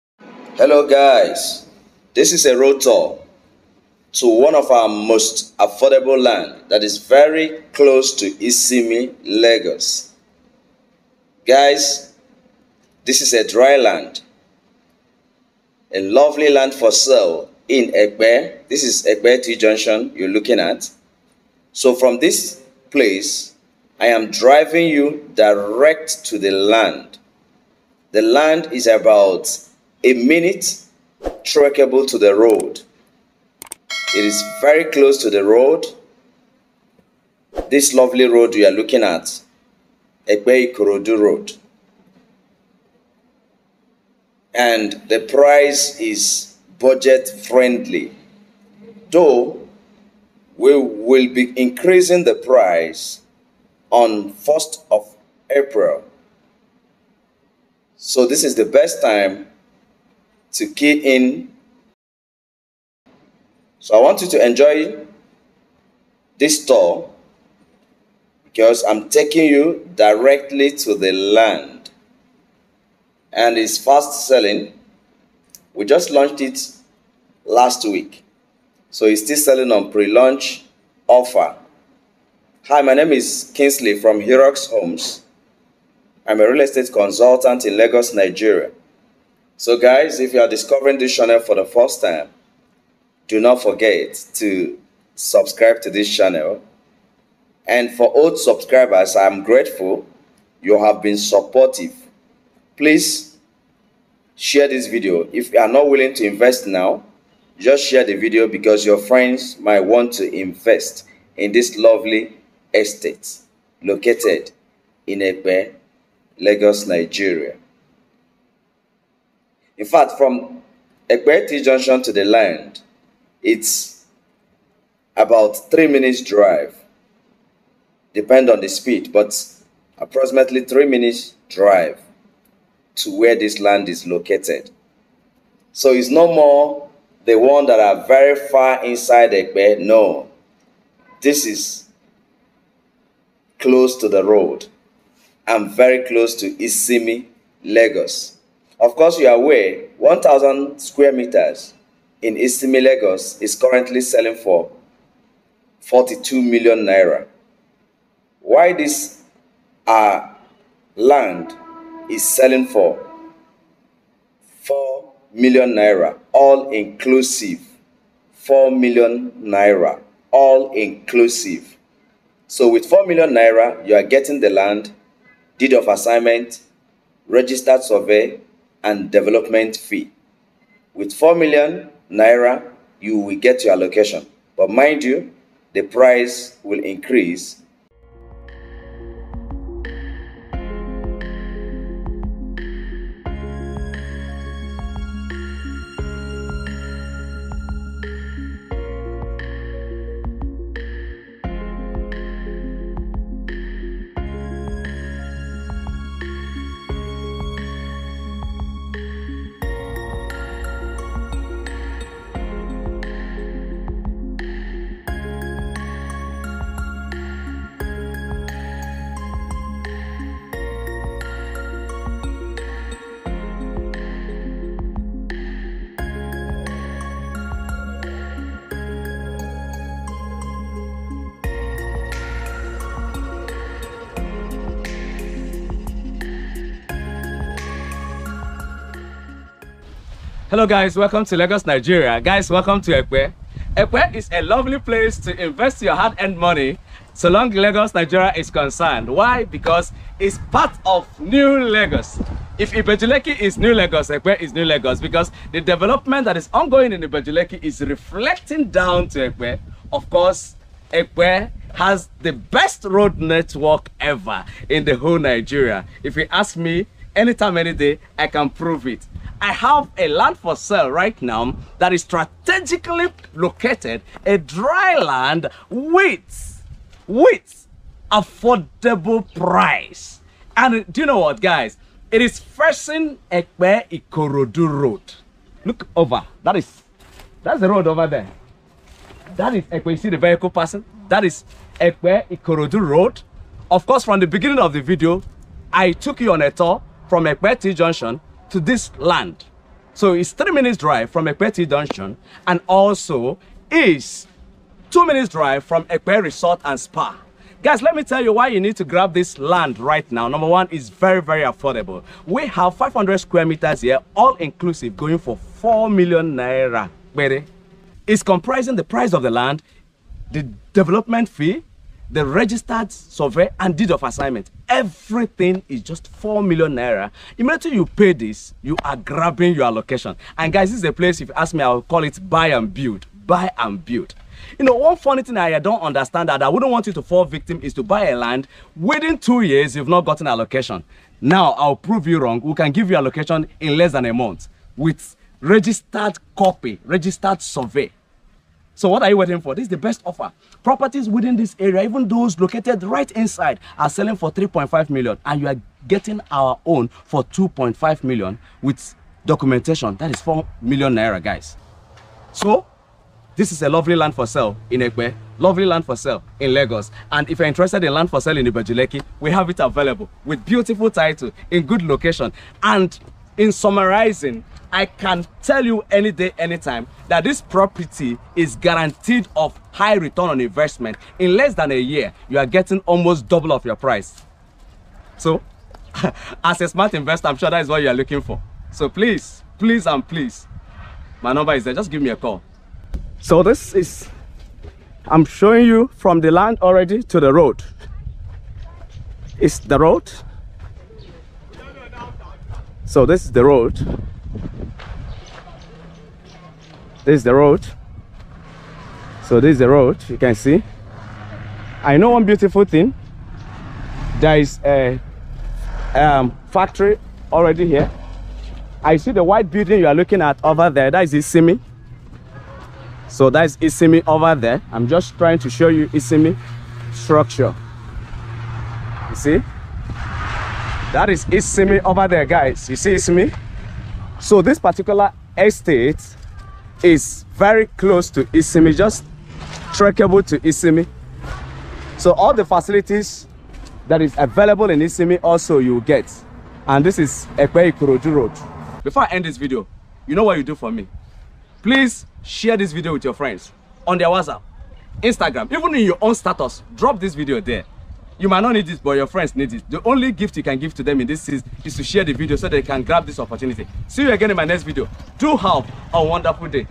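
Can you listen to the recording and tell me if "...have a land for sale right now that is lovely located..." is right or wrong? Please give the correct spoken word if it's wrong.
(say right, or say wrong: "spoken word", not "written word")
wrong: "strategically", not "lovely".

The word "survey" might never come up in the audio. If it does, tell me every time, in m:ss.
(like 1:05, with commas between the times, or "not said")
2:57, 5:22, 5:47.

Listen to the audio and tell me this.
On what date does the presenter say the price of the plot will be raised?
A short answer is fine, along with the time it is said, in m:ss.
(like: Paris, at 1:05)
1st of April, at 0:54.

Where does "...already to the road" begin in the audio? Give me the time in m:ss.
6:36.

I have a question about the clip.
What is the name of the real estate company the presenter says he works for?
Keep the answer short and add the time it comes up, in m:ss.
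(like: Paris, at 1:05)
Herox Homes, at 1:24.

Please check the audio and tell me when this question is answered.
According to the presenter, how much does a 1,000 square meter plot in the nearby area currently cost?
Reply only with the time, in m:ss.
2:35.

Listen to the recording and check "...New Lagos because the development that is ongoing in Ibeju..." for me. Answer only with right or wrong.
right.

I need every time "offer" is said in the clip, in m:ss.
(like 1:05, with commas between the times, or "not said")
1:21, 5:50.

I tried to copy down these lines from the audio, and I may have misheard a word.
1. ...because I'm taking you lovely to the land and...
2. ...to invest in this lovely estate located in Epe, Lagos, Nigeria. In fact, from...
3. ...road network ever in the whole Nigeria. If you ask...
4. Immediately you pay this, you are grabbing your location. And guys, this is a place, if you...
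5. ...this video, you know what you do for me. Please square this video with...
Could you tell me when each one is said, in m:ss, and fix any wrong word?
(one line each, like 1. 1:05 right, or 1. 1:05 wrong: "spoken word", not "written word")
1. 1:08 wrong: "directly", not "lovely"
2. 1:50 right
3. 4:22 right
4. 5:27 wrong: "allocation", not "location"
5. 7:29 wrong: "share", not "square".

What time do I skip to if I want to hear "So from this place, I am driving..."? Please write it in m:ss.
0:21.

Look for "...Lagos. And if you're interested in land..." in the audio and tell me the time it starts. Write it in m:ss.
6:06.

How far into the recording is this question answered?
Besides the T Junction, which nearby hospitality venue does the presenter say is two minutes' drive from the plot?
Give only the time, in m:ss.
5:05.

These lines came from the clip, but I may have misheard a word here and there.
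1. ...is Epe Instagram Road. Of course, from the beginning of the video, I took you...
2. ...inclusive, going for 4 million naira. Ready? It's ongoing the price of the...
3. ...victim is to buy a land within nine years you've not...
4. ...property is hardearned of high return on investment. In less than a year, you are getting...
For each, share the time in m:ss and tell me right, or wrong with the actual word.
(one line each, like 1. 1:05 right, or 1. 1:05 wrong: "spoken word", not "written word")
1. 4:51 wrong: "Ikorodu", not "Instagram"
2. 5:14 wrong: "comprising", not "ongoing"
3. 5:37 wrong: "two", not "nine"
4. 6:17 wrong: "guaranteed", not "hardearned".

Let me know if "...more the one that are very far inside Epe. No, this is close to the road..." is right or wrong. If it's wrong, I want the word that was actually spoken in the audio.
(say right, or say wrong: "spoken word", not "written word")
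right.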